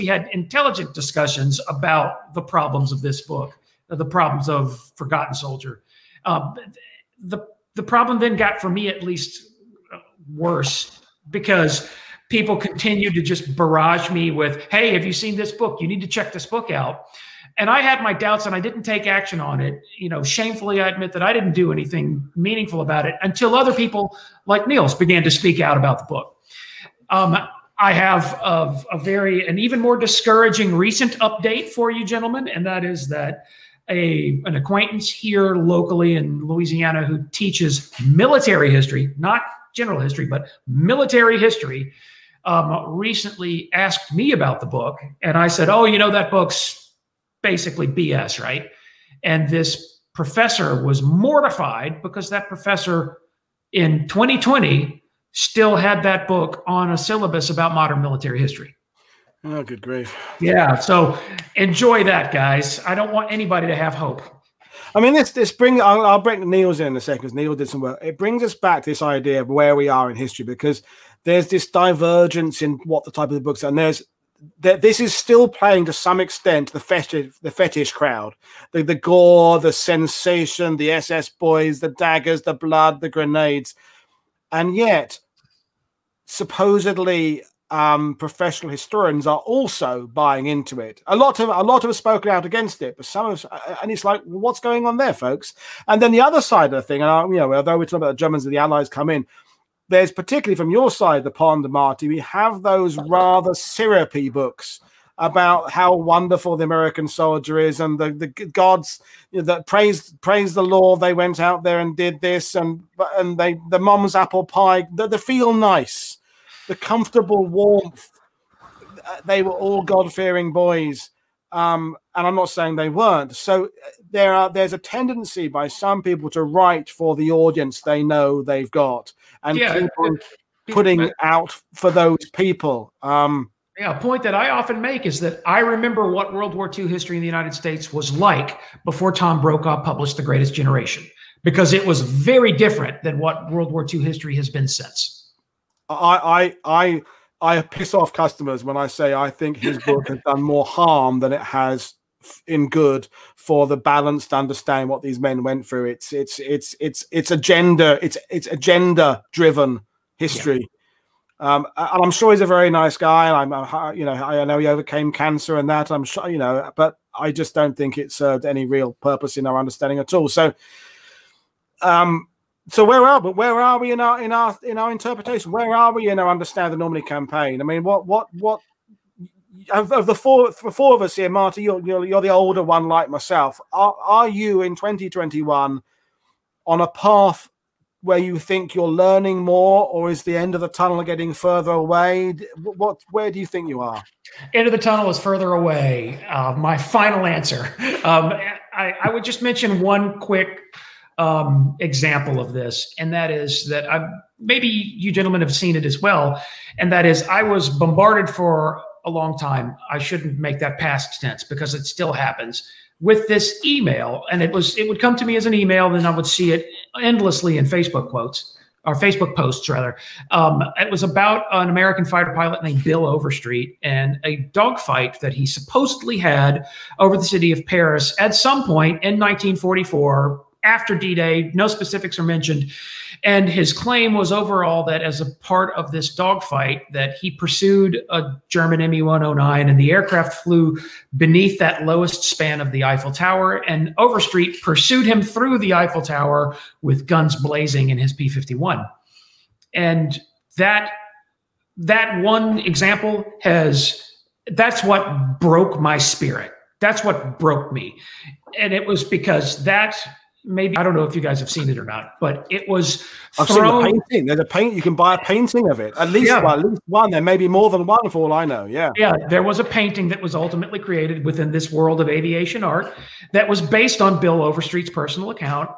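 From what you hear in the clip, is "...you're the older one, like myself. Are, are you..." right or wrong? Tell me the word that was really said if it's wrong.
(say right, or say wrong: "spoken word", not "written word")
right.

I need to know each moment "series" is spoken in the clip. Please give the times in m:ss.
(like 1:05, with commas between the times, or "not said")
not said.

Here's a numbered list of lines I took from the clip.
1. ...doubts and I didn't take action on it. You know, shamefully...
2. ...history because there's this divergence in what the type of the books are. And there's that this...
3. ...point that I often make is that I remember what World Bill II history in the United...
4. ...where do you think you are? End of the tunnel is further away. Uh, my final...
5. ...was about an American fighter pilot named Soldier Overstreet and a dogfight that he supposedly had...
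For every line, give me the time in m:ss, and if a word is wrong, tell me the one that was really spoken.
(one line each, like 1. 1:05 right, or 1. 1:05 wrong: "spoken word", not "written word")
1. 0:18 right
2. 1:10 right
3. 2:14 wrong: "War", not "Bill"
4. 3:13 right
5. 3:40 wrong: "Bill", not "Soldier".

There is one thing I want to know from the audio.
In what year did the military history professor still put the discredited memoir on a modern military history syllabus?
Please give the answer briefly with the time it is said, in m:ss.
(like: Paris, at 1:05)
2020, at 0:54.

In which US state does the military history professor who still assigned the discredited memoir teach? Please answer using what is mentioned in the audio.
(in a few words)
Louisiana.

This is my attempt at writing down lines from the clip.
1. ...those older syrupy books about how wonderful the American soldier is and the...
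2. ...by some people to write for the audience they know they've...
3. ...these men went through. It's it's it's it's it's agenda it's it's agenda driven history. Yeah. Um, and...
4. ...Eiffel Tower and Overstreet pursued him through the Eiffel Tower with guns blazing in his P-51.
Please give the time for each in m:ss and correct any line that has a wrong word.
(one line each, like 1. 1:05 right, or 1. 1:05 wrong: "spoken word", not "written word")
1. 1:42 wrong: "rather", not "older"
2. 2:05 right
3. 2:35 right
4. 4:02 right.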